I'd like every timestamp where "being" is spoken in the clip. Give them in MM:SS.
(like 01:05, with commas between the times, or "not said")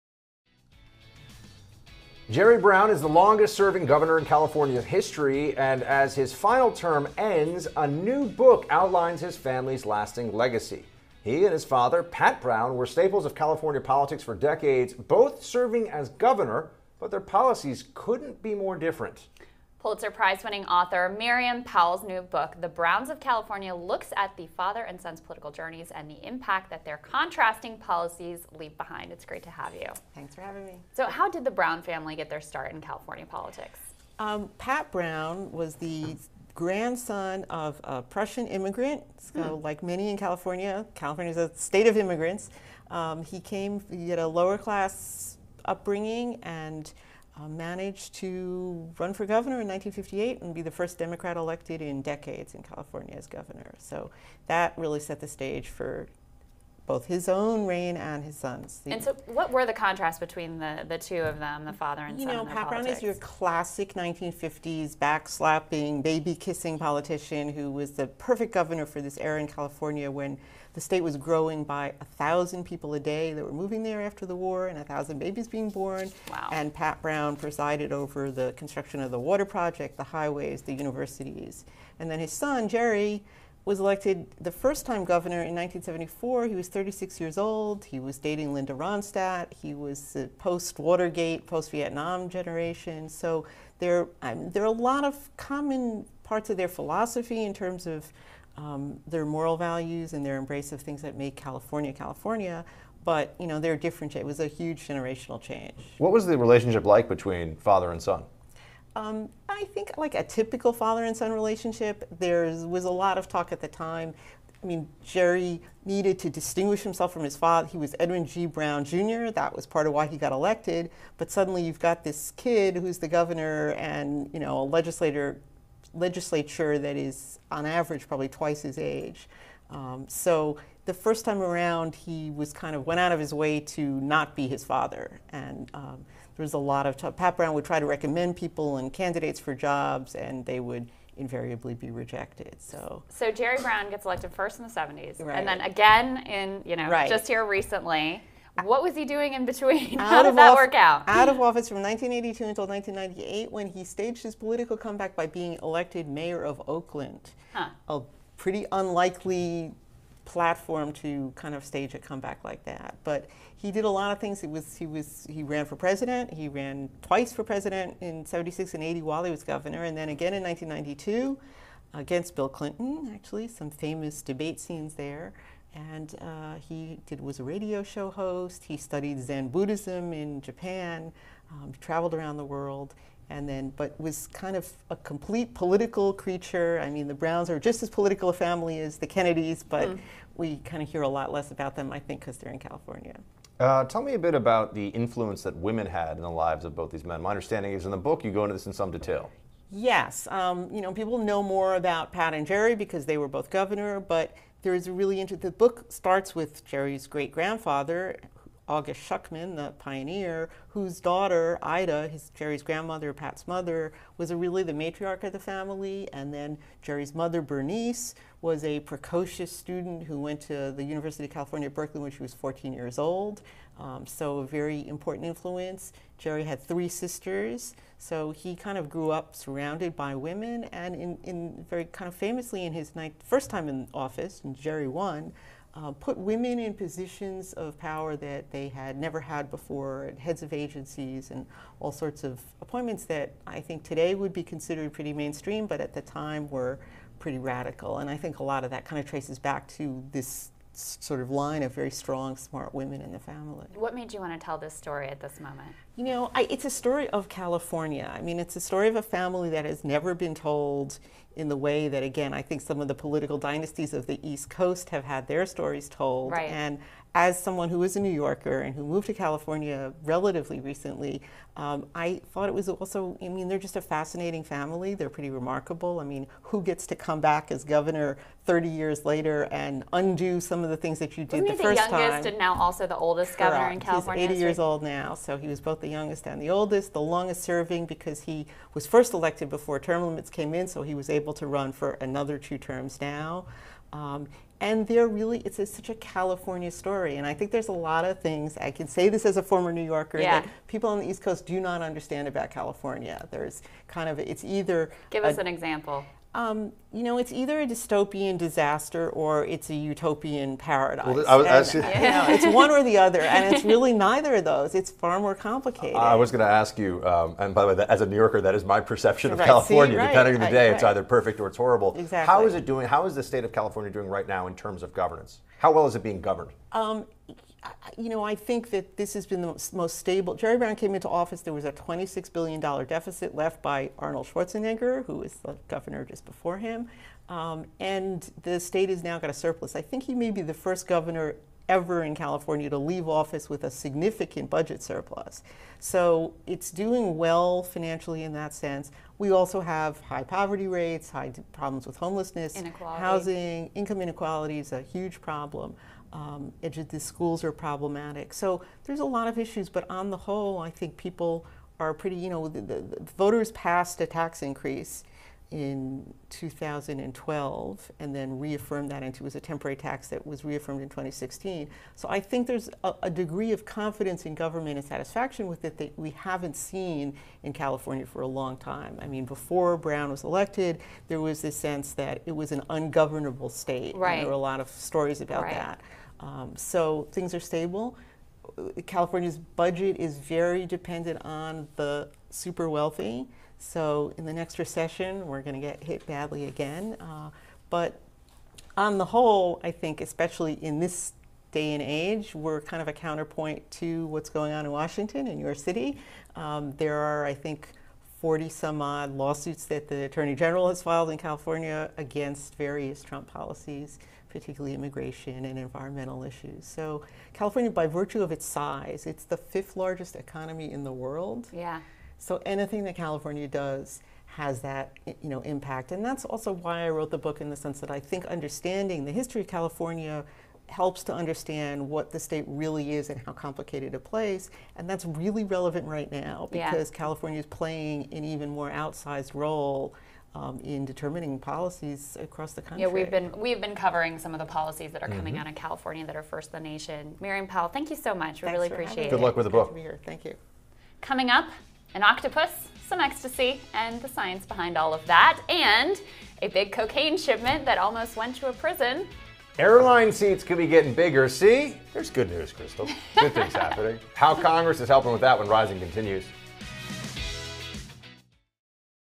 01:15, 02:35, 05:26.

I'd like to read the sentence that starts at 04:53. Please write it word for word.
Um, and they're really, it's a, such a California story.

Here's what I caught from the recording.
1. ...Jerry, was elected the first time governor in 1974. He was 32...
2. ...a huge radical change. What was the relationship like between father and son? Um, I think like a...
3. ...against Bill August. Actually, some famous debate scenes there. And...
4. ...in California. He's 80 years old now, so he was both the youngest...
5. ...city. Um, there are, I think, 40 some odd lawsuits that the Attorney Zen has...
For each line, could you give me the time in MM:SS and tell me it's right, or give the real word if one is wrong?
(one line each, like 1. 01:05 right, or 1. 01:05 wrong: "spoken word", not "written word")
1. 01:22 wrong: "36", not "32"
2. 01:44 wrong: "generational", not "radical"
3. 02:51 wrong: "Clinton", not "August"
4. 04:43 right
5. 06:45 wrong: "General", not "Zen".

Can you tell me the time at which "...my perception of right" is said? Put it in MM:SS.
05:18.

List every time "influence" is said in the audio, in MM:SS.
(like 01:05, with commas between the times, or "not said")
03:14, 03:45.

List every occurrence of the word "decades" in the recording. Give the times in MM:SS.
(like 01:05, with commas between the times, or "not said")
00:14, 00:52.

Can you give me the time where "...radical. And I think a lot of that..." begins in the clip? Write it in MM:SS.
04:07.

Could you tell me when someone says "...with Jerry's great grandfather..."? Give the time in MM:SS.
03:26.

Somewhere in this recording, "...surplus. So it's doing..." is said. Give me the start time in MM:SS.
05:44.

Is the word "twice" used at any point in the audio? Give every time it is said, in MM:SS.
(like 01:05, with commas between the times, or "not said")
02:08, 02:47.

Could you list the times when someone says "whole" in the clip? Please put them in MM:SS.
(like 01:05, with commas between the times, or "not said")
06:00, 06:39.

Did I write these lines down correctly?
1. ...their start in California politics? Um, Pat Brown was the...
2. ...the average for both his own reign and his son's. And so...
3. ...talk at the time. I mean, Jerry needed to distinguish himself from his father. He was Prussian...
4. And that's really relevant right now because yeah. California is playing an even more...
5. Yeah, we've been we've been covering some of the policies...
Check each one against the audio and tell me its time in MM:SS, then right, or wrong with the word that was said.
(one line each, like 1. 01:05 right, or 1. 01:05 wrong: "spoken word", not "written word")
1. 00:32 right
2. 00:55 wrong: "stage", not "average"
3. 01:53 wrong: "Edwin", not "Prussian"
4. 07:14 right
5. 07:22 right.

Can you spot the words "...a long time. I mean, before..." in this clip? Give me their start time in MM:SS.
06:18.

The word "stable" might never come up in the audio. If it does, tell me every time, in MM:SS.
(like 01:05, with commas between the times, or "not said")
05:29, 06:27.